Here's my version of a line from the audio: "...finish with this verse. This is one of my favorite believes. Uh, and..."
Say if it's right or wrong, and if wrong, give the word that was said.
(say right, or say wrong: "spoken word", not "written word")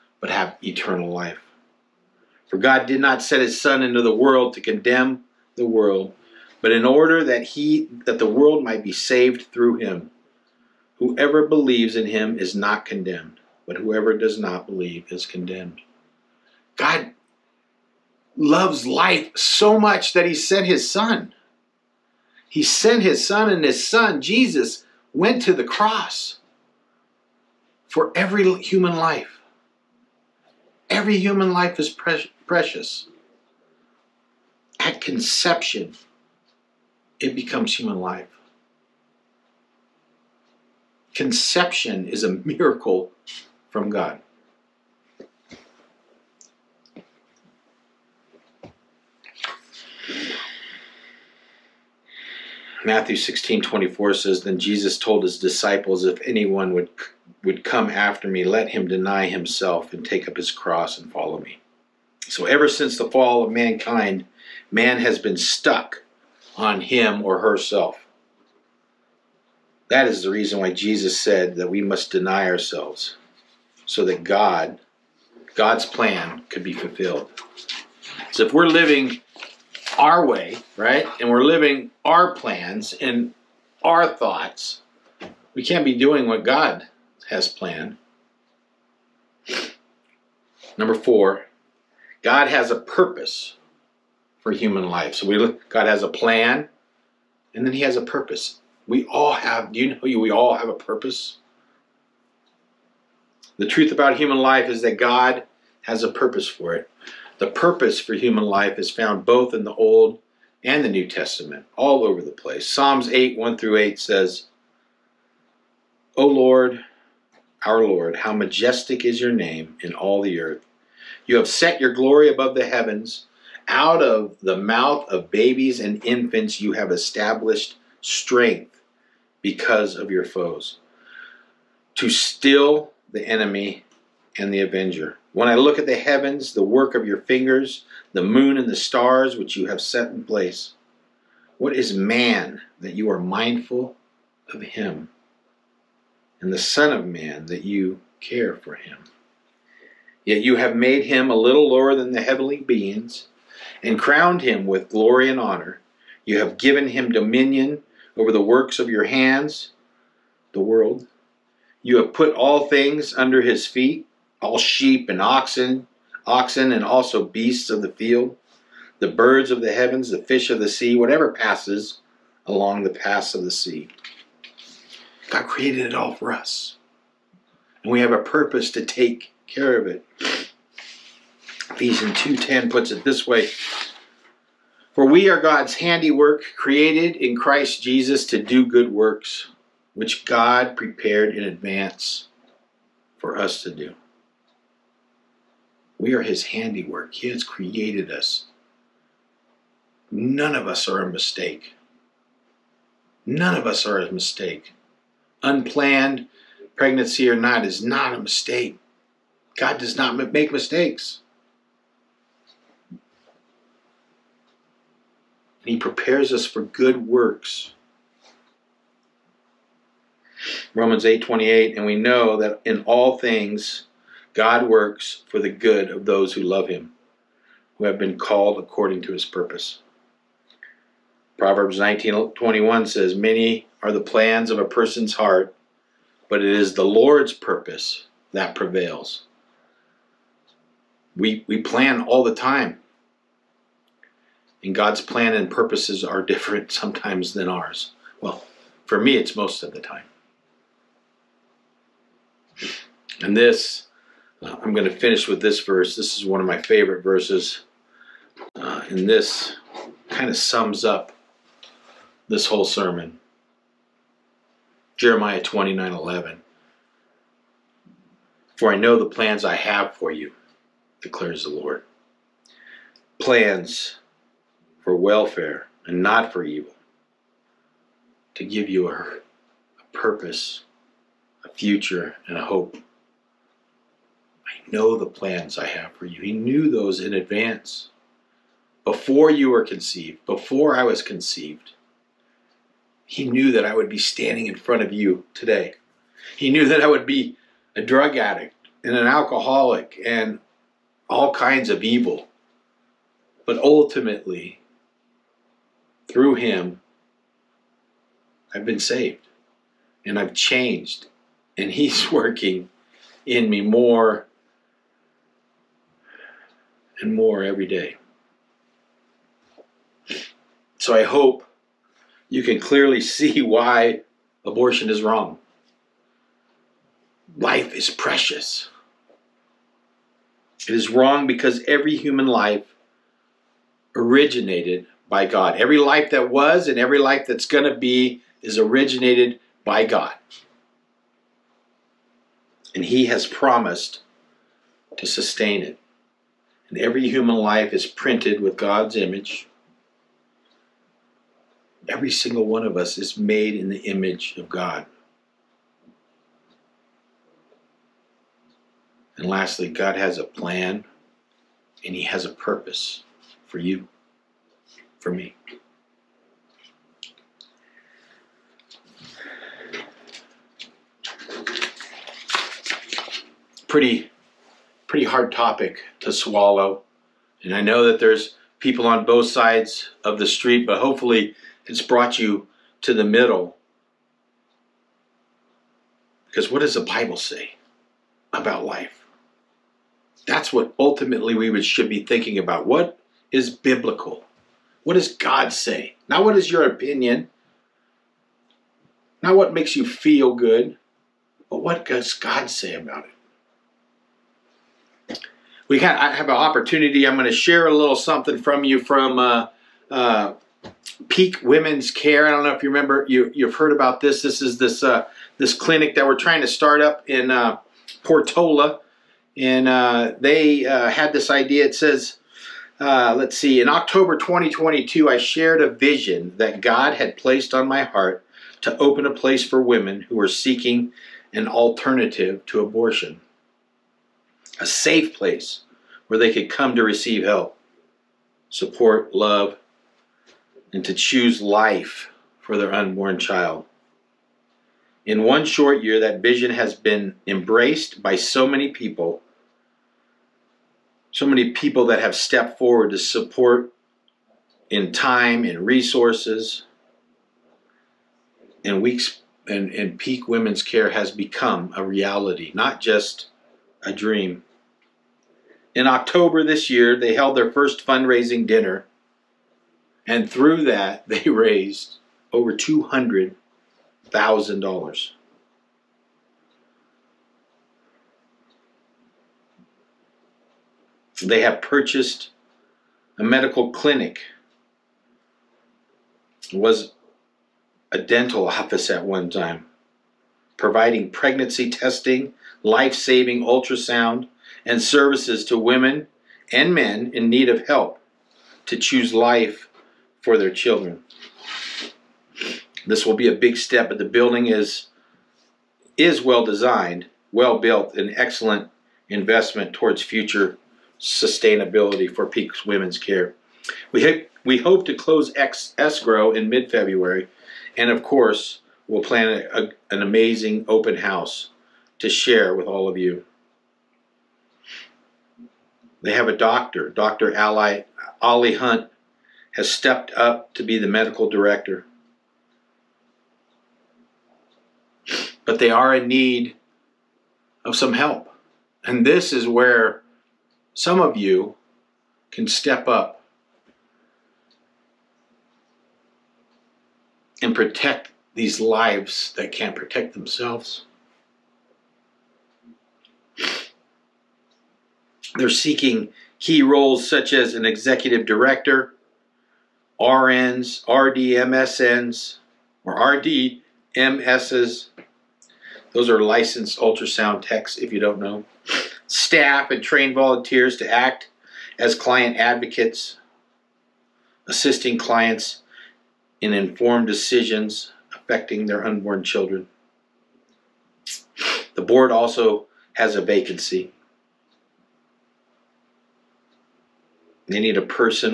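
wrong: "verses", not "believes".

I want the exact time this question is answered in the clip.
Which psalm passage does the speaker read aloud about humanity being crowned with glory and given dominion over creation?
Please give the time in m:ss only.
1:52.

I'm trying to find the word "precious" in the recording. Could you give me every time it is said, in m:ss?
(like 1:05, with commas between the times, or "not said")
0:32, 5:27.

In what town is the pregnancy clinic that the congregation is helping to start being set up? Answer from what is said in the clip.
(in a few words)
Portola.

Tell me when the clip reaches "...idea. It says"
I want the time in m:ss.
7:01.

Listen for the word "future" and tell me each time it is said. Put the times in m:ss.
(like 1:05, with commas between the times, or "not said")
4:41, 8:30.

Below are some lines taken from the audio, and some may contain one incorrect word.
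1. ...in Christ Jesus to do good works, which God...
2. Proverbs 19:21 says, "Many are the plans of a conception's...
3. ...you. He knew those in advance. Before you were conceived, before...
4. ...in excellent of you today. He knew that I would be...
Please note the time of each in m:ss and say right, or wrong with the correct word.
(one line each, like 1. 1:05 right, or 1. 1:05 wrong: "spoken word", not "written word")
1. 3:07 right
2. 3:51 wrong: "person", not "conception"
3. 4:46 right
4. 4:54 wrong: "front", not "excellent".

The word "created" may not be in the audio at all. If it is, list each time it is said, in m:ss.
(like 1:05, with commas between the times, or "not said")
2:55, 3:06, 3:17.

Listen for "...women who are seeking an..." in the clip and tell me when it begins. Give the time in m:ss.
7:09.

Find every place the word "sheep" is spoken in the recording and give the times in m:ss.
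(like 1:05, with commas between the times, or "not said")
2:44.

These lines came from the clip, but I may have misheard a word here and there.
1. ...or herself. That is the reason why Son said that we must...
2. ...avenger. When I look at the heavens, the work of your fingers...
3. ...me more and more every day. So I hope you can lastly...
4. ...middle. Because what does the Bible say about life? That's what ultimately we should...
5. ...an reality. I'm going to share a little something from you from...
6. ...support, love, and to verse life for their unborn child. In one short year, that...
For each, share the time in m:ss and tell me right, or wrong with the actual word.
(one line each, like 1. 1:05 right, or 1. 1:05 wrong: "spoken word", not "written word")
1. 1:07 wrong: "Jesus", not "Son"
2. 2:14 right
3. 5:13 wrong: "clearly", not "lastly"
4. 6:23 right
5. 6:46 wrong: "opportunity", not "reality"
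6. 7:18 wrong: "choose", not "verse".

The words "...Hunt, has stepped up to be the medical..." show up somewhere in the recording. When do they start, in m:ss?
8:48.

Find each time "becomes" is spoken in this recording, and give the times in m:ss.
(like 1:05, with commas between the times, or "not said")
0:37, 7:41.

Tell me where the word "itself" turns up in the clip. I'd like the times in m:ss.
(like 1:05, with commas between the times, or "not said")
not said.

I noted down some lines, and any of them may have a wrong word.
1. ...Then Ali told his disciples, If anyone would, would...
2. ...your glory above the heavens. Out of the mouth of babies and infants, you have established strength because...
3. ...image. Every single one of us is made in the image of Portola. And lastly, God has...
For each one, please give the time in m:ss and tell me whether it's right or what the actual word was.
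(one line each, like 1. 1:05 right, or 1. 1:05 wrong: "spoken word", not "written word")
1. 0:54 wrong: "Jesus", not "Ali"
2. 2:01 right
3. 5:48 wrong: "God", not "Portola".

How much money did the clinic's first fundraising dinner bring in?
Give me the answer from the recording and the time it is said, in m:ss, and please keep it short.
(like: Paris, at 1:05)
over $200,000, at 7:52.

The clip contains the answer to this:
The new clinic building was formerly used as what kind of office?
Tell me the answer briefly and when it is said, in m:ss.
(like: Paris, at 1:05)
a dental office, at 8:07.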